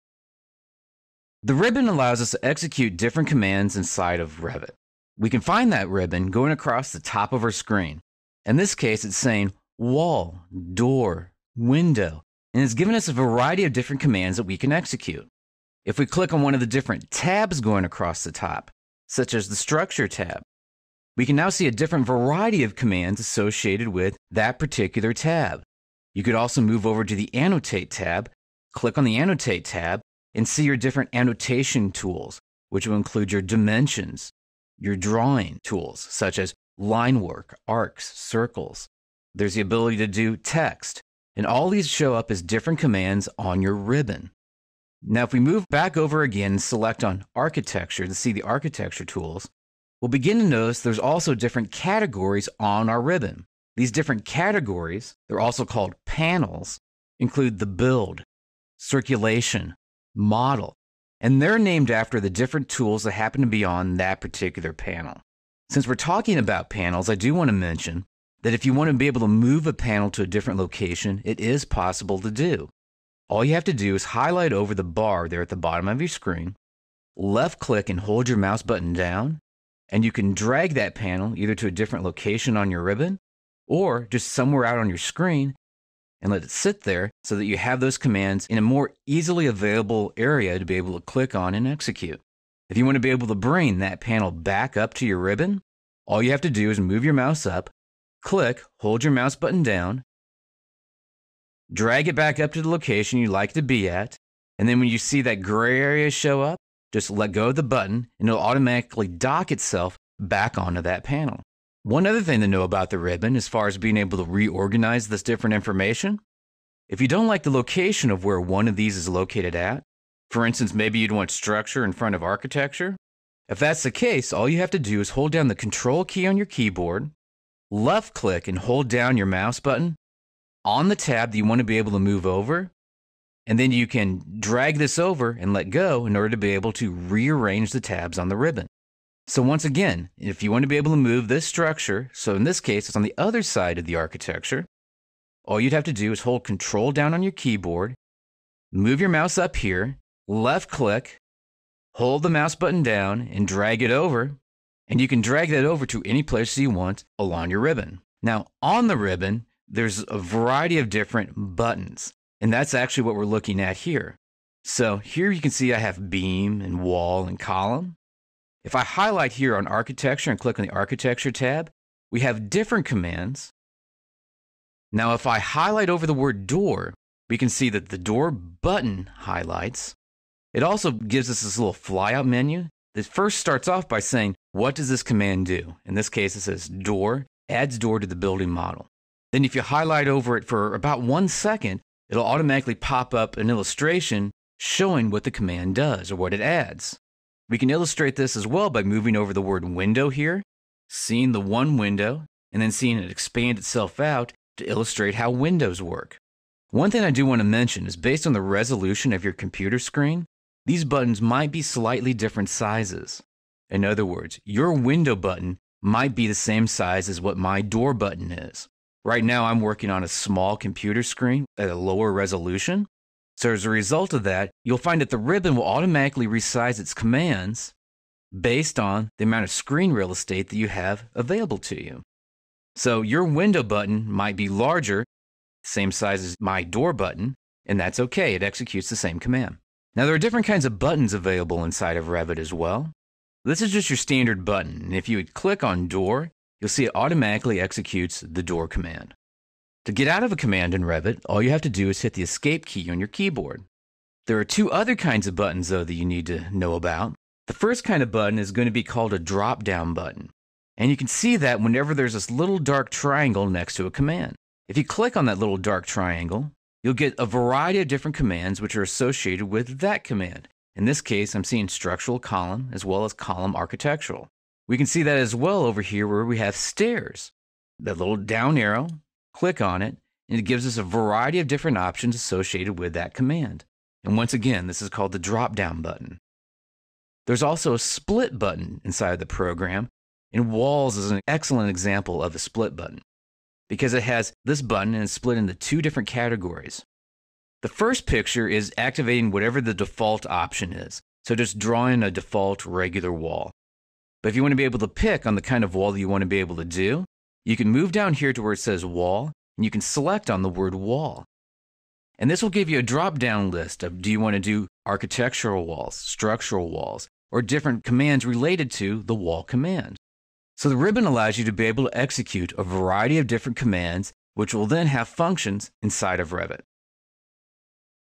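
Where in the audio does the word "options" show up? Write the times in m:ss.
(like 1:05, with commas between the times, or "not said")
4:41, 5:00.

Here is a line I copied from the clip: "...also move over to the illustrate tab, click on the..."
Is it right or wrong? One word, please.
wrong.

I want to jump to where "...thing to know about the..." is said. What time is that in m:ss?
1:52.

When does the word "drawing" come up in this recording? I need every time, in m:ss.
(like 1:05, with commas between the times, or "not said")
0:34, 5:01.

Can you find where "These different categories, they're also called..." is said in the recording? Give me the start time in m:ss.
0:53.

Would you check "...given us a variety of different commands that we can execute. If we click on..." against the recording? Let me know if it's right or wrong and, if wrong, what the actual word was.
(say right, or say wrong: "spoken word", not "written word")
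right.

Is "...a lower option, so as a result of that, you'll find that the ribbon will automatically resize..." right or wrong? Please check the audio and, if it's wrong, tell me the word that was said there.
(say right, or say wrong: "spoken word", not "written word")
wrong: "resolution", not "option".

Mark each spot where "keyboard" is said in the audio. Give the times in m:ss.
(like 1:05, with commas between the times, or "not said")
2:06, 2:27, 4:13.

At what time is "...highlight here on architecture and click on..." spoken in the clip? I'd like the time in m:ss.
2:48.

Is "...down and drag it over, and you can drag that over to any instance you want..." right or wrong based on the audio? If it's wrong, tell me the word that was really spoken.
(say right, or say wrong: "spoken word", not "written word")
wrong: "place", not "instance".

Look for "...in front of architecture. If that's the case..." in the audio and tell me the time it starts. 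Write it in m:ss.
2:01.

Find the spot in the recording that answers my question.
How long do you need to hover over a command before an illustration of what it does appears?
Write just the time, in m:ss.
3:10.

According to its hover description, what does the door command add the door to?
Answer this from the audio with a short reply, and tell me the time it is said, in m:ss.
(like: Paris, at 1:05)
the building model, at 3:08.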